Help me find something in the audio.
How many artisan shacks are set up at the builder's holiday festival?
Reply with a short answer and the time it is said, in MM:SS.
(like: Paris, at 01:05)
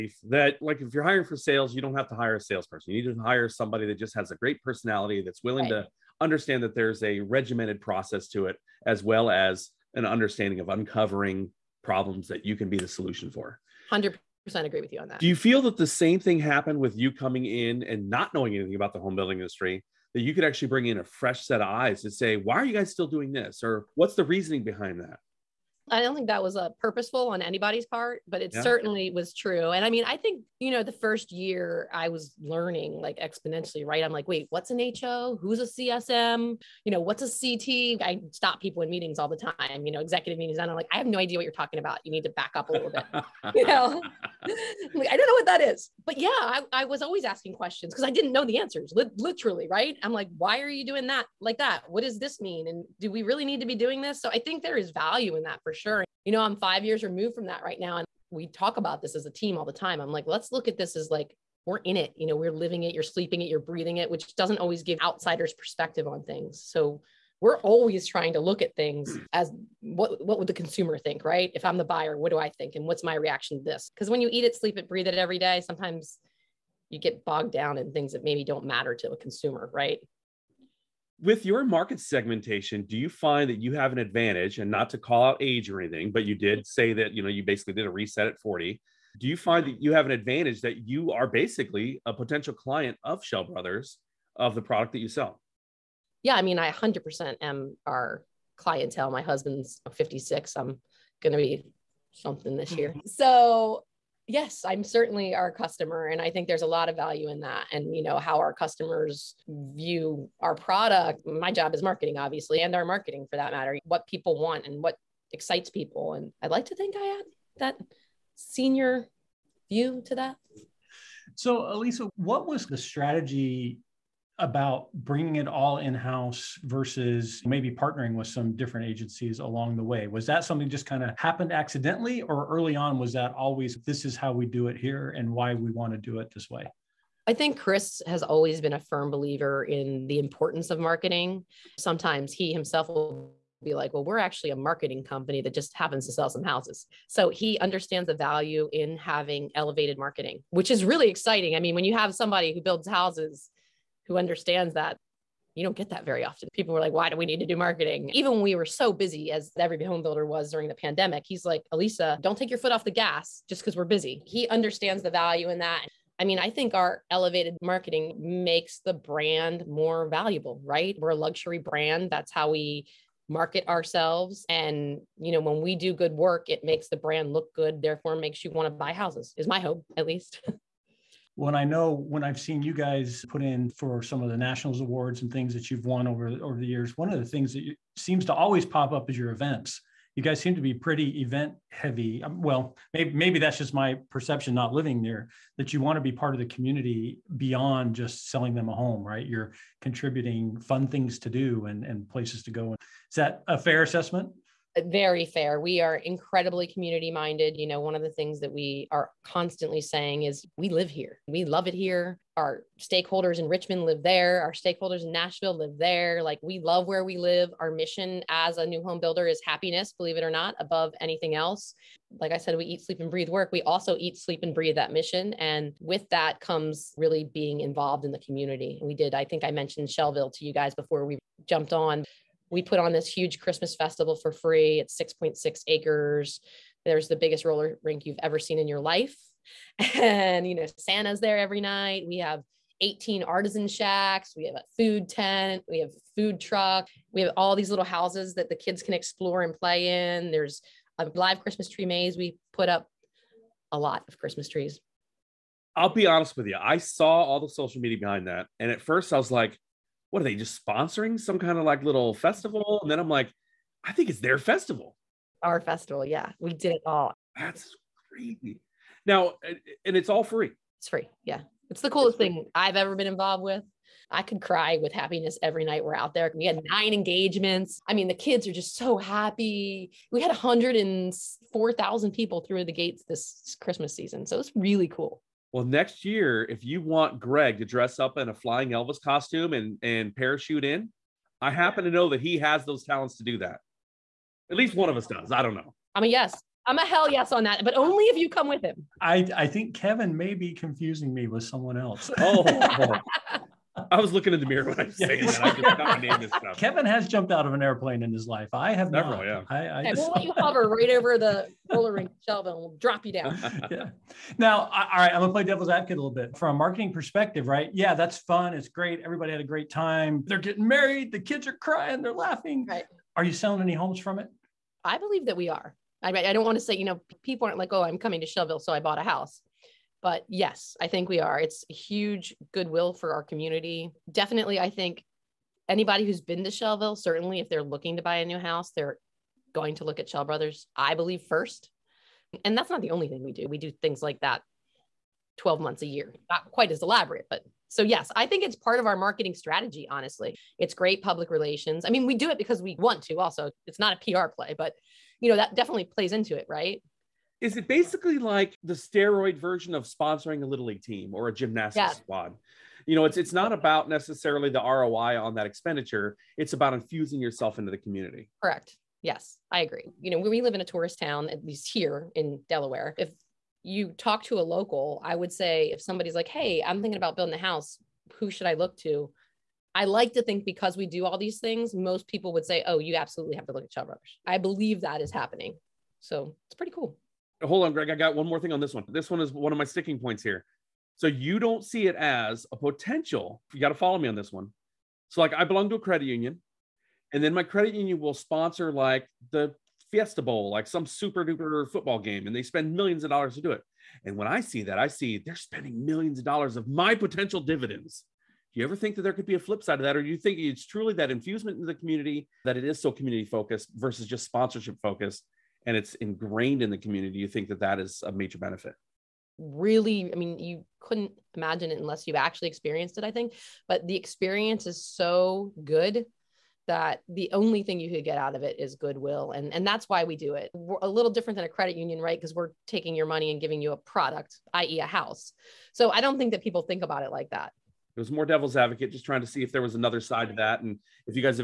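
18, at 04:02.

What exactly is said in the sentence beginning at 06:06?
It's about infusing yourself into the community.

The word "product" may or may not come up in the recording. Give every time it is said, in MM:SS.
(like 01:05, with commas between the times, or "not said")
01:34, 01:50, 07:13.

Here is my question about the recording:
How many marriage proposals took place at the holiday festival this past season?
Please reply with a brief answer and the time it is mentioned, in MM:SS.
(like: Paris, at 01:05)
9, at 04:36.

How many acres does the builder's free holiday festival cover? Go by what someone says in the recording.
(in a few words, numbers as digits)
6.6 acres.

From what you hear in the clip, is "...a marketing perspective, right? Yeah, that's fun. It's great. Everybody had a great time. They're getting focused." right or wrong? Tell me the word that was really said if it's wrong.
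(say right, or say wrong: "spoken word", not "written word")
wrong: "married", not "focused".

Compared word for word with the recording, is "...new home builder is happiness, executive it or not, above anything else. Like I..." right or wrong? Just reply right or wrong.
wrong.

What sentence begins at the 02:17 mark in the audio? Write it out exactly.
I think Chris has always been a firm believer in the importance of marketing.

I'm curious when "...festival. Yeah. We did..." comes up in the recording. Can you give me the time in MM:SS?
04:25.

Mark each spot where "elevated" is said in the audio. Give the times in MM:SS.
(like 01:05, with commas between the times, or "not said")
02:29, 02:47.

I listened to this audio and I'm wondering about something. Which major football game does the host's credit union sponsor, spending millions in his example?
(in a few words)
Fiesta Bowl.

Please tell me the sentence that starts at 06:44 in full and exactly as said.
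And when I see that, I see they're spending millions of dollars of my potential dividends.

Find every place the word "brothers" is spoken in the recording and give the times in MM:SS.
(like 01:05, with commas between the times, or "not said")
01:33, 05:40, 06:23.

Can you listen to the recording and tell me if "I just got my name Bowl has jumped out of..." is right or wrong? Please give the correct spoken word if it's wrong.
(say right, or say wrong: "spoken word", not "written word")
wrong: "Kevin", not "Bowl".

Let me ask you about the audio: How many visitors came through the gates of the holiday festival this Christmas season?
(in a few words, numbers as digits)
104,000.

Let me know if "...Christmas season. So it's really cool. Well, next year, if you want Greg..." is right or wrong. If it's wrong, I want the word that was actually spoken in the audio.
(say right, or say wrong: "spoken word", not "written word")
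right.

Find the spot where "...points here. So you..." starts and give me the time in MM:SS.
06:29.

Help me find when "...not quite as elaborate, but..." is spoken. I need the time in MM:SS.
05:46.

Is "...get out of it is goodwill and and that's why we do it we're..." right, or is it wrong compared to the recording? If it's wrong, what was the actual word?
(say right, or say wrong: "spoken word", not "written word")
right.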